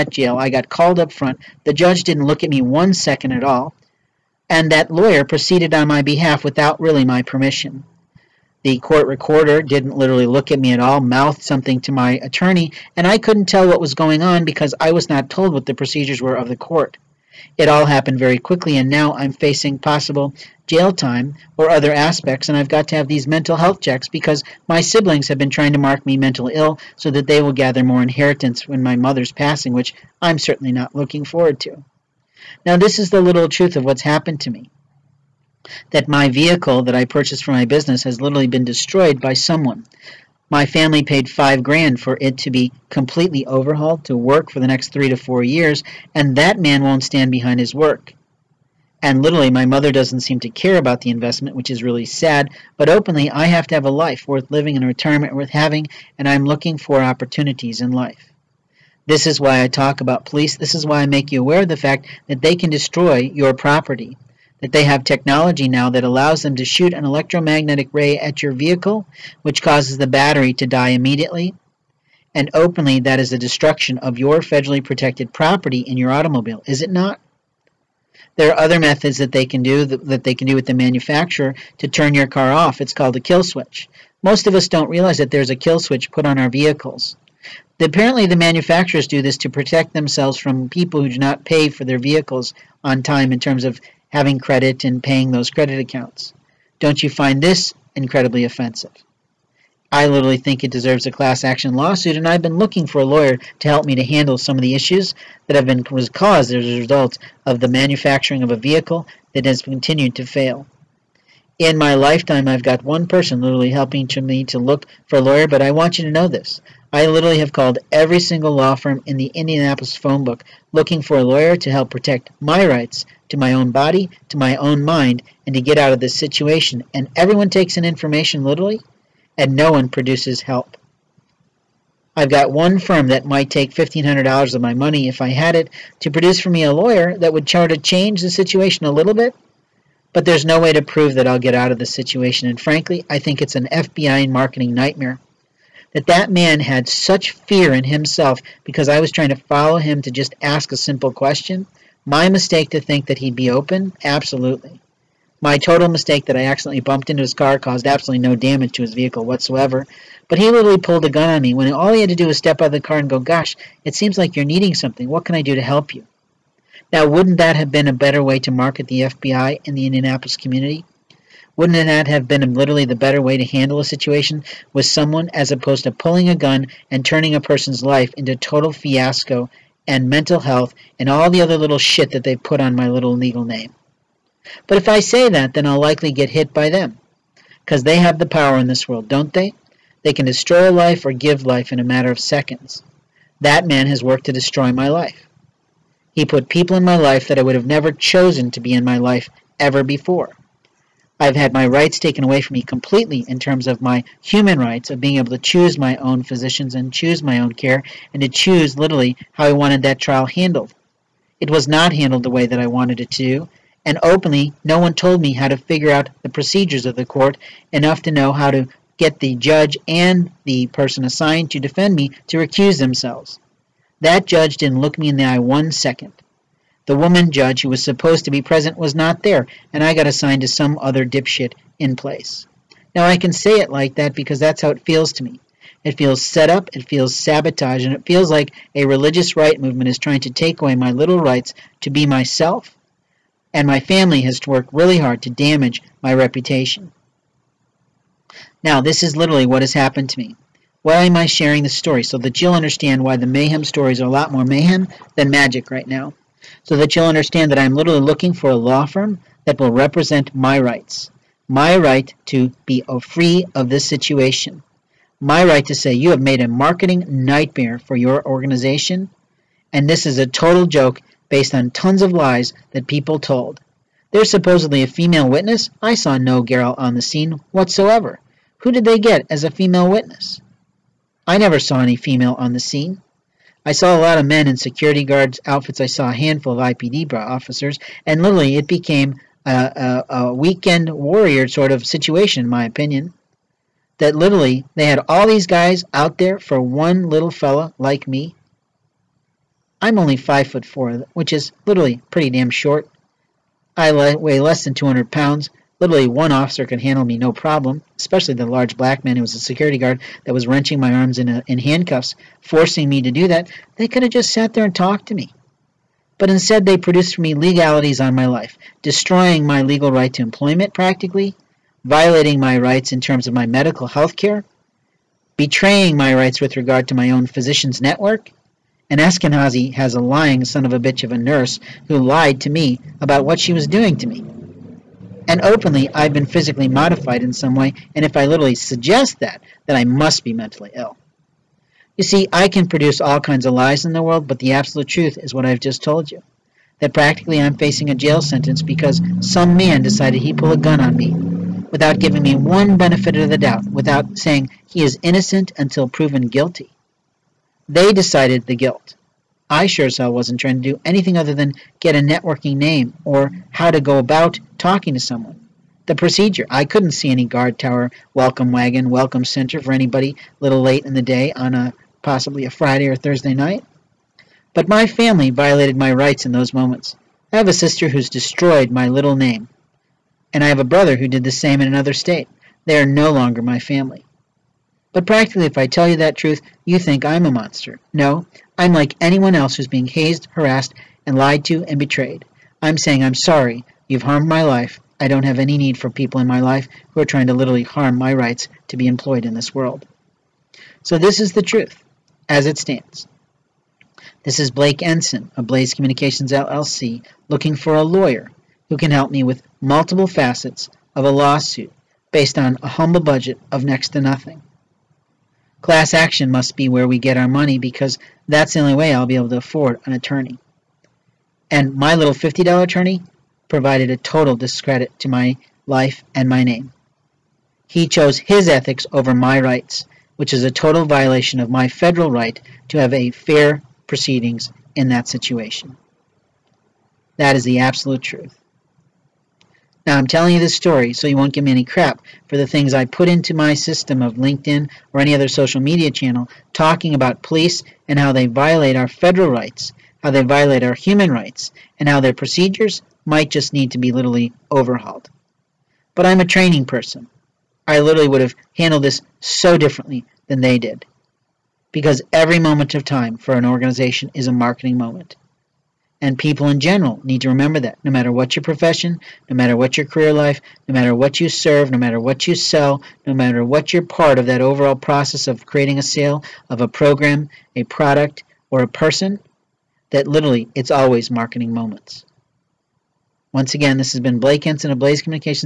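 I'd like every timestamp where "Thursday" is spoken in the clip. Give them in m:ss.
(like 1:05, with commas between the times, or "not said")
6:12.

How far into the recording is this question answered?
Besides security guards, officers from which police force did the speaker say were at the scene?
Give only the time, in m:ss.
4:46.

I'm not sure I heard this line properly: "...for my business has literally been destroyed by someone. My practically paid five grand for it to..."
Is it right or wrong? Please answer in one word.
wrong.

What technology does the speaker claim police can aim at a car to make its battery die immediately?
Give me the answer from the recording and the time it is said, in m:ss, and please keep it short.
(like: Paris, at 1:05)
electromagnetic ray, at 1:07.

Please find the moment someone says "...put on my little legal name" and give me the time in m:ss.
3:02.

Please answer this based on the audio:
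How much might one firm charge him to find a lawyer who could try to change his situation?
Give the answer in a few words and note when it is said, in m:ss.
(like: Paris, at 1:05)
$1,500, at 2:13.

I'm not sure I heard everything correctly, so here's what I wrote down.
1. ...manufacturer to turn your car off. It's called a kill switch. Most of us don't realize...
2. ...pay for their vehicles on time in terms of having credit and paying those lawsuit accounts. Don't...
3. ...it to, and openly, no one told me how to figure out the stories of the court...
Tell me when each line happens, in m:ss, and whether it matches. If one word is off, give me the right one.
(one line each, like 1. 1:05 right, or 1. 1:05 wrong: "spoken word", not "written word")
1. 1:20 right
2. 1:31 wrong: "credit", not "lawsuit"
3. 3:32 wrong: "procedures", not "stories".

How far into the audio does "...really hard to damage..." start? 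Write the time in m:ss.
4:04.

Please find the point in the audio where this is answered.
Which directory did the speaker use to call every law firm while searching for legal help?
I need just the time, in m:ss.
1:59.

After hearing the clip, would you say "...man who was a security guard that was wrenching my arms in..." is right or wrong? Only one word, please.
right.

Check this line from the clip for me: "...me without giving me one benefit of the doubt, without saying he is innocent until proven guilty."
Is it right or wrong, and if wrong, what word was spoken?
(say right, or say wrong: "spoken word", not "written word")
right.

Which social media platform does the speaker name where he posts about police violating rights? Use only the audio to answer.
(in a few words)
LinkedIn.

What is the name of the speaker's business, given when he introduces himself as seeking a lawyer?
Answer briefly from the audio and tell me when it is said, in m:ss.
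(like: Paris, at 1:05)
Blaze Communications LLC, at 6:45.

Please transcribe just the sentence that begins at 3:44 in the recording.
That judge didn't look me in the eye one second.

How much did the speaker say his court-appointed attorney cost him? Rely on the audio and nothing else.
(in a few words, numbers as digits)
$50.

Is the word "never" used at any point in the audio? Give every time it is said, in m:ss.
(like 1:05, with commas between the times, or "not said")
3:17, 4:41.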